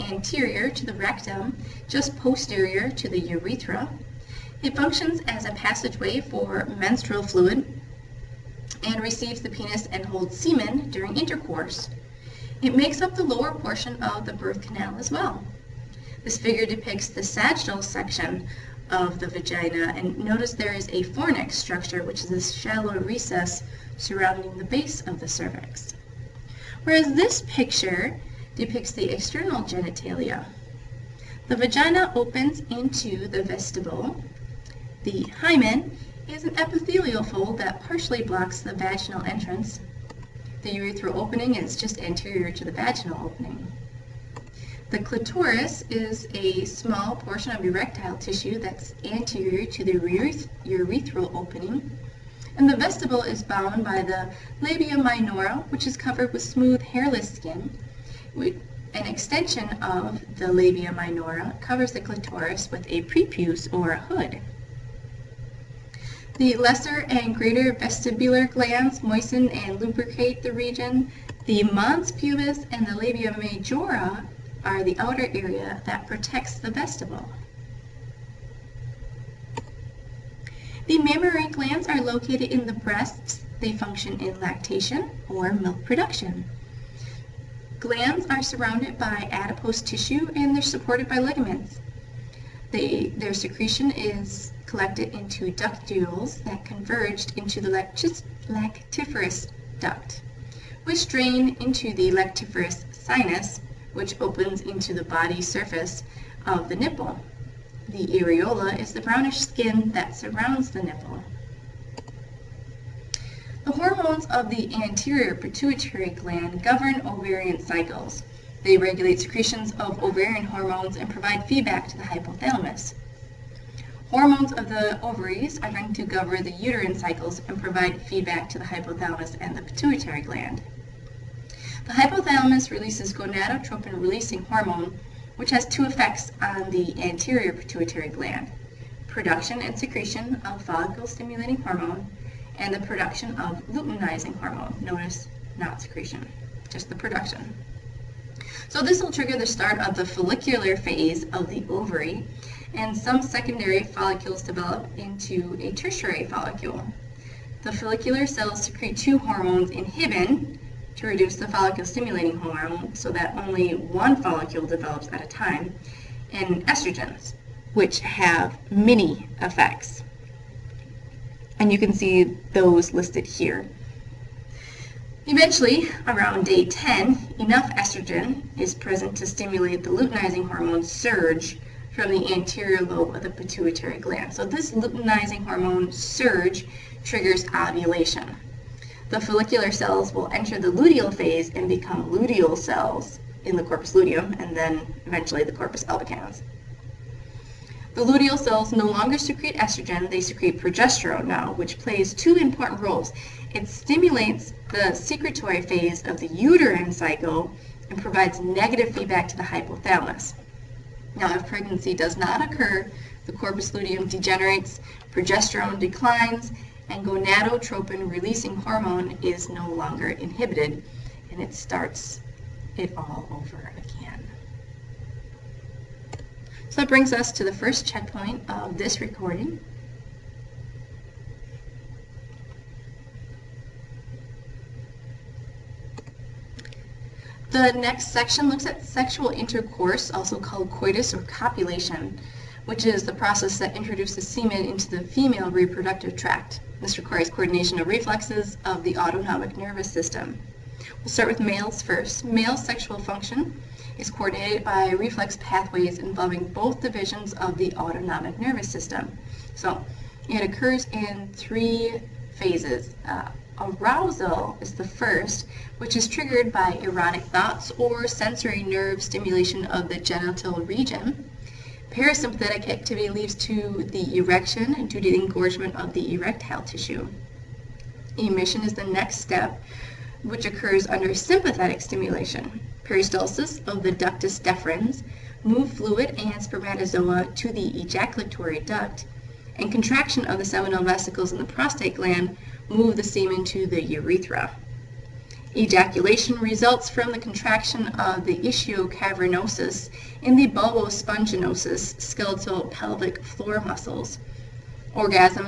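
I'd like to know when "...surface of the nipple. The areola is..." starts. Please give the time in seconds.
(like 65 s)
105 s.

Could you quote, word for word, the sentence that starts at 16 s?
This figure depicts the sagittal section of the vagina.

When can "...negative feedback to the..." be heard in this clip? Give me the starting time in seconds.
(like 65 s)
208 s.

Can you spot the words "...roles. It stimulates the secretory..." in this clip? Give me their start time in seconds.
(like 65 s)
202 s.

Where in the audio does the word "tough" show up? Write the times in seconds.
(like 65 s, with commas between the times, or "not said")
not said.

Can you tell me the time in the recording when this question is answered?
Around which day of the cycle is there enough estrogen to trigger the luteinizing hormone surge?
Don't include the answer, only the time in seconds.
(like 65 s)
176 s.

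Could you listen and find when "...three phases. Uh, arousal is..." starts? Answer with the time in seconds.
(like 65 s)
261 s.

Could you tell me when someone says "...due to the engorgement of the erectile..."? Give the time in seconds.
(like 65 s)
274 s.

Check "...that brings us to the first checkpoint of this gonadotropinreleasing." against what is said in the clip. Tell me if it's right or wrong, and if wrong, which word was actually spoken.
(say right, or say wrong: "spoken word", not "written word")
wrong: "recording", not "gonadotropinreleasing".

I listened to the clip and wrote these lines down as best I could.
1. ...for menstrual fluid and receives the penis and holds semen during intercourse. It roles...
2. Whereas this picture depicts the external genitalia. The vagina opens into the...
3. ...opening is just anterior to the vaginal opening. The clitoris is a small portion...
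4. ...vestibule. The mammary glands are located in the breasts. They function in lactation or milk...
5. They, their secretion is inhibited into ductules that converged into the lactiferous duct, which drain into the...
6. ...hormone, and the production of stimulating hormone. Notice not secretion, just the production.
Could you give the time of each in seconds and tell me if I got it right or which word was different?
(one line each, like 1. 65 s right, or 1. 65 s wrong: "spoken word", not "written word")
1. 6 s wrong: "makes", not "roles"
2. 26 s right
3. 41 s right
4. 76 s right
5. 92 s wrong: "collected", not "inhibited"
6. 141 s wrong: "luteinizing", not "stimulating".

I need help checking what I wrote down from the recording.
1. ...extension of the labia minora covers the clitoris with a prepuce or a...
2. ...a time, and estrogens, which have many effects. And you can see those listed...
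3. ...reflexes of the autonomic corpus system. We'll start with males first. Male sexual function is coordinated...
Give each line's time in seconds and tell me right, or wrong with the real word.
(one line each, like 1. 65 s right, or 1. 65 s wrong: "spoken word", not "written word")
1. 59 s right
2. 165 s right
3. 247 s wrong: "nervous", not "corpus".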